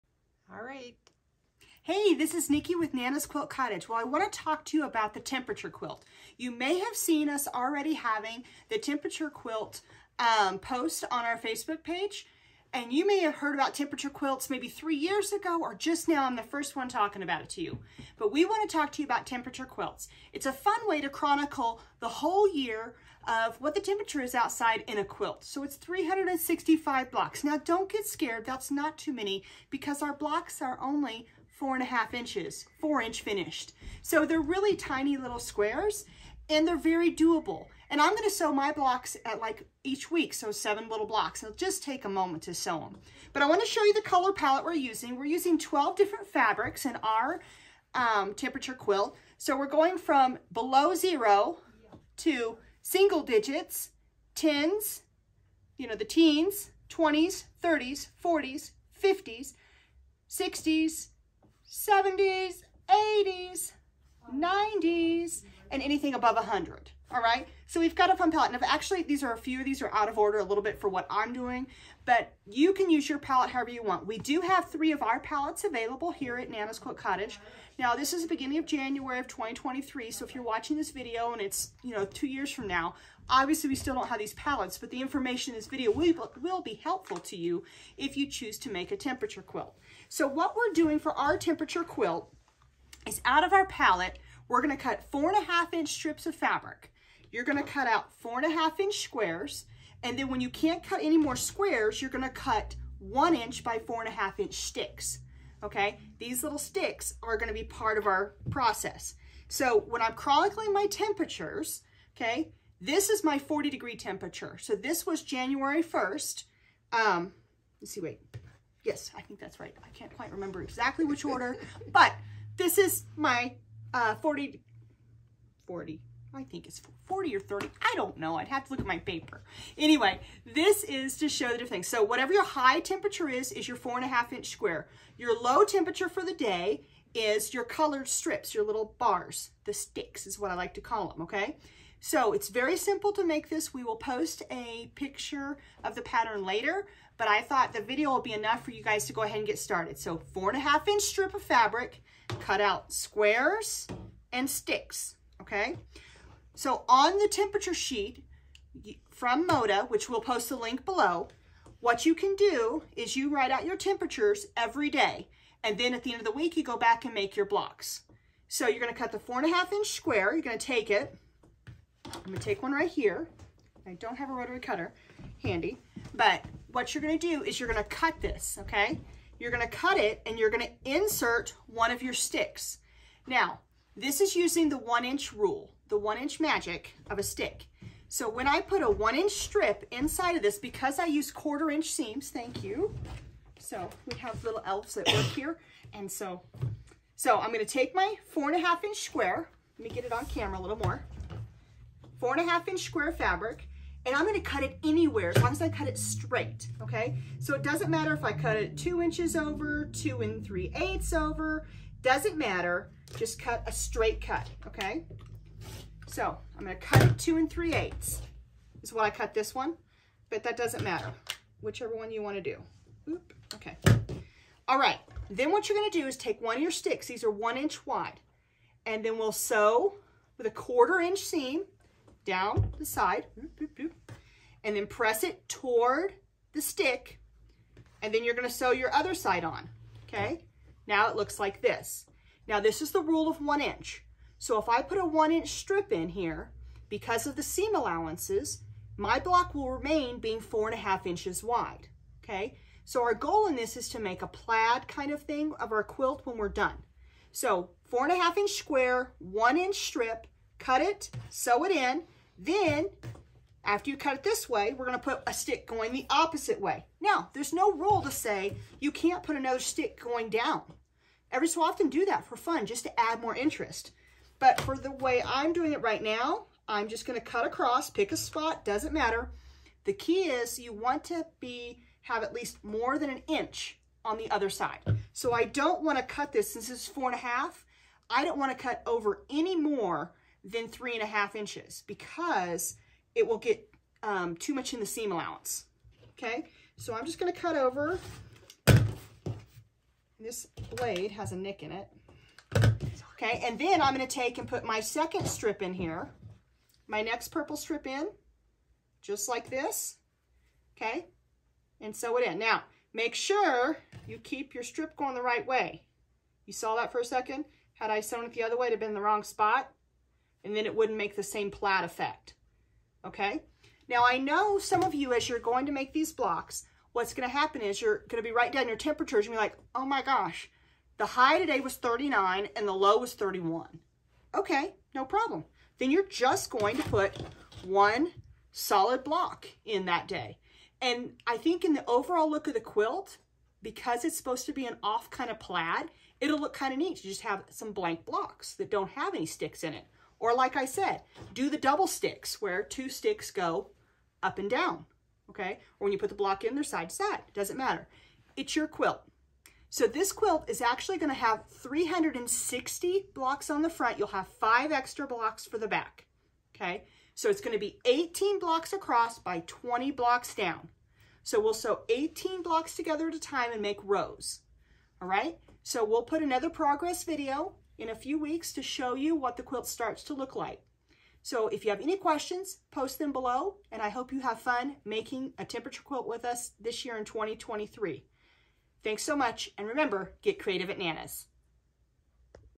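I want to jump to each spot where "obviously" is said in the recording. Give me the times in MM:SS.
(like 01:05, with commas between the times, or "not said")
01:23.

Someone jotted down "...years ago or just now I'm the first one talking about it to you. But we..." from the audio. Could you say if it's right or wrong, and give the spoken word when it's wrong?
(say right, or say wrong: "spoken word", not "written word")
right.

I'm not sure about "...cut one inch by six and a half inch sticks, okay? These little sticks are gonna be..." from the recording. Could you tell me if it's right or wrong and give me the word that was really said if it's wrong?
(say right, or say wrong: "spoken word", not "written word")
wrong: "four", not "six".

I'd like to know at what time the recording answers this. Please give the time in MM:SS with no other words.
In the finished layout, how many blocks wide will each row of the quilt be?
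06:07.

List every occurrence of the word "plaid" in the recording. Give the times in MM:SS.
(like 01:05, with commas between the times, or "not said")
04:14, 05:21, 05:45.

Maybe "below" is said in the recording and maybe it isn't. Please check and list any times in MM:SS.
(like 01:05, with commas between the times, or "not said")
00:50, 02:40, 06:23.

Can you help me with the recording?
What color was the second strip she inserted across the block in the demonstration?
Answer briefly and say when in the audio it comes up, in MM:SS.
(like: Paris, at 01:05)
Purple, at 05:07.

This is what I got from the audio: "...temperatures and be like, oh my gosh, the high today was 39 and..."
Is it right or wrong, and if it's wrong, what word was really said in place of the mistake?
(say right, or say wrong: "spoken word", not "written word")
right.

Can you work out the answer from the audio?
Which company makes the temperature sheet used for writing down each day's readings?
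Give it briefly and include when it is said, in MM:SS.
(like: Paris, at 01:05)
MODA, at 02:39.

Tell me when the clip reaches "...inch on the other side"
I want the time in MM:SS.
04:43.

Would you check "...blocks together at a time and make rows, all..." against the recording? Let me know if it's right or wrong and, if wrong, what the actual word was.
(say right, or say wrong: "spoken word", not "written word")
right.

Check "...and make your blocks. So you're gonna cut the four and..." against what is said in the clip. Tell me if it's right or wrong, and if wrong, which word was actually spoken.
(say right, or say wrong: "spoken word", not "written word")
right.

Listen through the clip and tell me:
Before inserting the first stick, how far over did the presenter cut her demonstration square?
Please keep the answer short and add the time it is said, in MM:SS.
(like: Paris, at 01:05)
2 and 3/8 inches, at 03:37.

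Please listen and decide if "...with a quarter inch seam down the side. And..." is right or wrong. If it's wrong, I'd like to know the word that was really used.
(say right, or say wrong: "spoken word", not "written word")
right.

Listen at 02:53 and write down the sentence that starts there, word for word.
I don't have a rotary cutter handy, but what you're gonna do is you're gonna cut this, okay?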